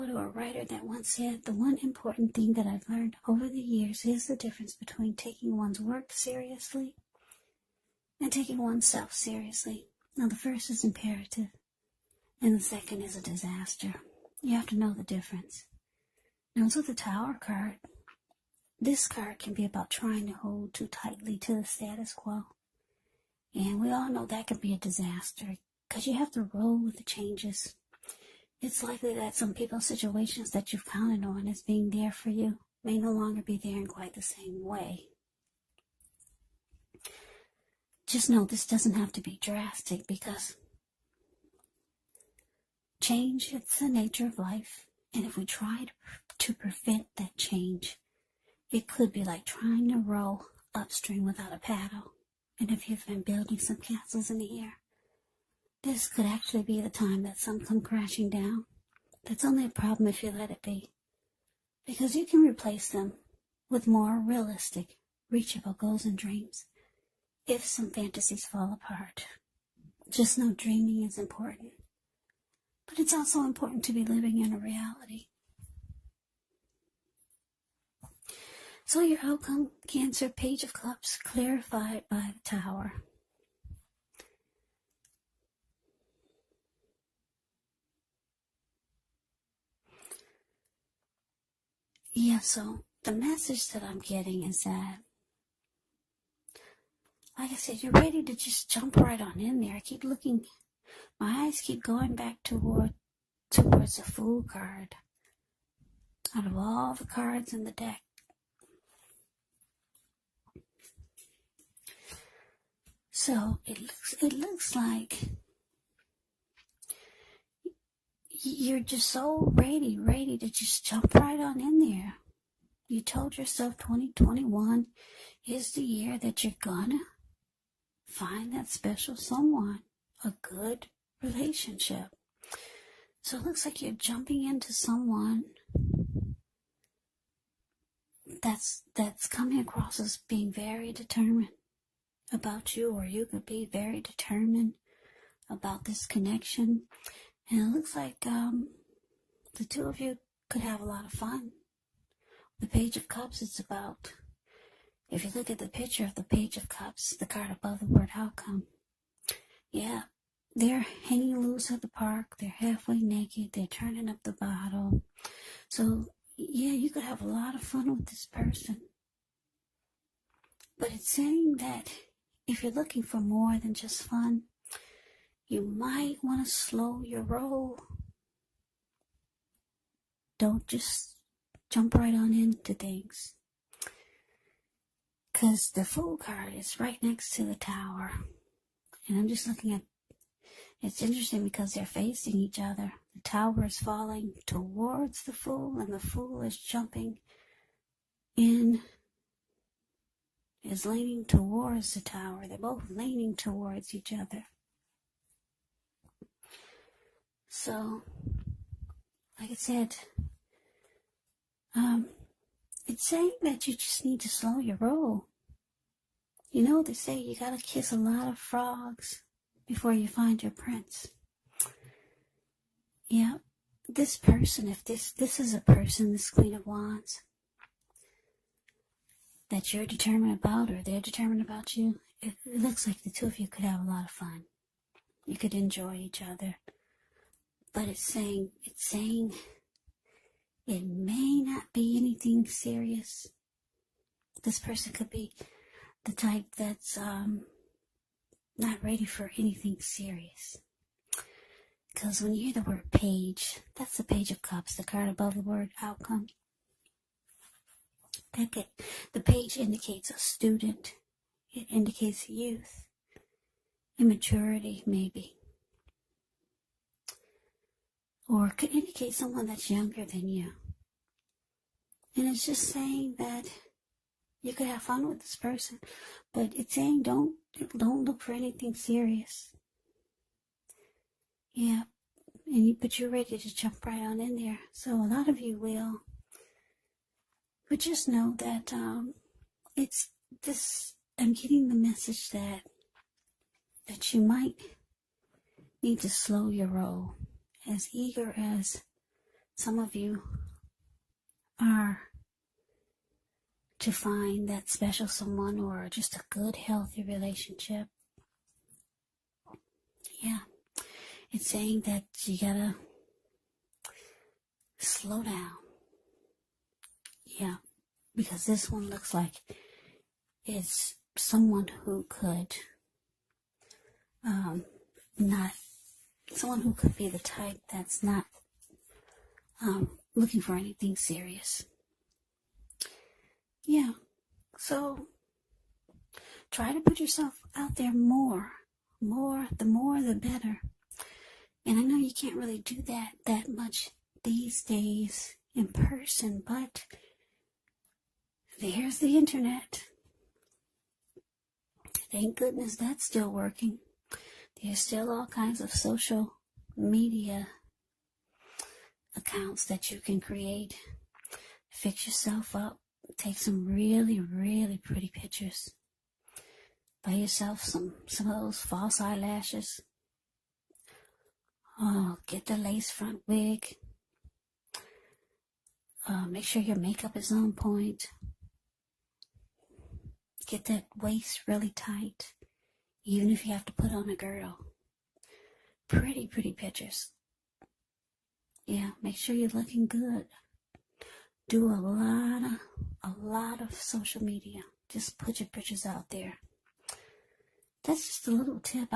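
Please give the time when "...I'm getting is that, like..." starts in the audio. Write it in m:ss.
1:33.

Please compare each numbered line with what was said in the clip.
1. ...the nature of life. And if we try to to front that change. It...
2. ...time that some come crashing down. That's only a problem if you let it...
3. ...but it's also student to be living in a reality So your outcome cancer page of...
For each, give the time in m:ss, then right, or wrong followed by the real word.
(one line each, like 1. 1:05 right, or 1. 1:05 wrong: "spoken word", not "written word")
1. 0:43 wrong: "prevent", not "front"
2. 0:56 right
3. 1:12 wrong: "important", not "student".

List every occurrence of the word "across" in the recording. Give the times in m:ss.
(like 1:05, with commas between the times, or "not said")
2:19.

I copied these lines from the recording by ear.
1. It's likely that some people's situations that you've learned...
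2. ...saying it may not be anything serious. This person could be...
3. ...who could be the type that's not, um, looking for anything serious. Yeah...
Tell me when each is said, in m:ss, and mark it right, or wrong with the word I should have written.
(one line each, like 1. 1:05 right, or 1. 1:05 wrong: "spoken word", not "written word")
1. 0:28 wrong: "counted", not "learned"
2. 3:58 right
3. 5:26 right.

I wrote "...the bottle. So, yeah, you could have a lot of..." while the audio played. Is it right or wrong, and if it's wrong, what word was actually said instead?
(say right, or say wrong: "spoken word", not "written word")
right.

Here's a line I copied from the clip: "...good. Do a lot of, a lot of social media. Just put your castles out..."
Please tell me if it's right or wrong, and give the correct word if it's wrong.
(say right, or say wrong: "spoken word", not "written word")
wrong: "pictures", not "castles".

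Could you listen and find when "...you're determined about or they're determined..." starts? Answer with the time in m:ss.
3:49.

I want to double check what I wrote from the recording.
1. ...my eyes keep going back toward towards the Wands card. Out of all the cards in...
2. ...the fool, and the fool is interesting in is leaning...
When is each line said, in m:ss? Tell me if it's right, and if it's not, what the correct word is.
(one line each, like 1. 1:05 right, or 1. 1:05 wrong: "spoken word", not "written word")
1. 1:41 wrong: "Fool", not "Wands"
2. 3:15 wrong: "jumping", not "interesting".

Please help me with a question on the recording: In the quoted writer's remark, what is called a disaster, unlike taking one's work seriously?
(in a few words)
Taking oneself seriously.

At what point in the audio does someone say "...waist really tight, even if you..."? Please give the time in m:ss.
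6:20.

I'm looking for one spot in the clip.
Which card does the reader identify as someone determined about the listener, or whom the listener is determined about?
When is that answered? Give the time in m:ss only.
3:46.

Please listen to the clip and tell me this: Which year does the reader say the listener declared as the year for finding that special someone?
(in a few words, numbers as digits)
2021.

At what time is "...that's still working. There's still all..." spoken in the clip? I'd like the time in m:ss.
5:52.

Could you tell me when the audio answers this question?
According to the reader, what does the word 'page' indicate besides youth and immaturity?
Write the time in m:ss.
4:20.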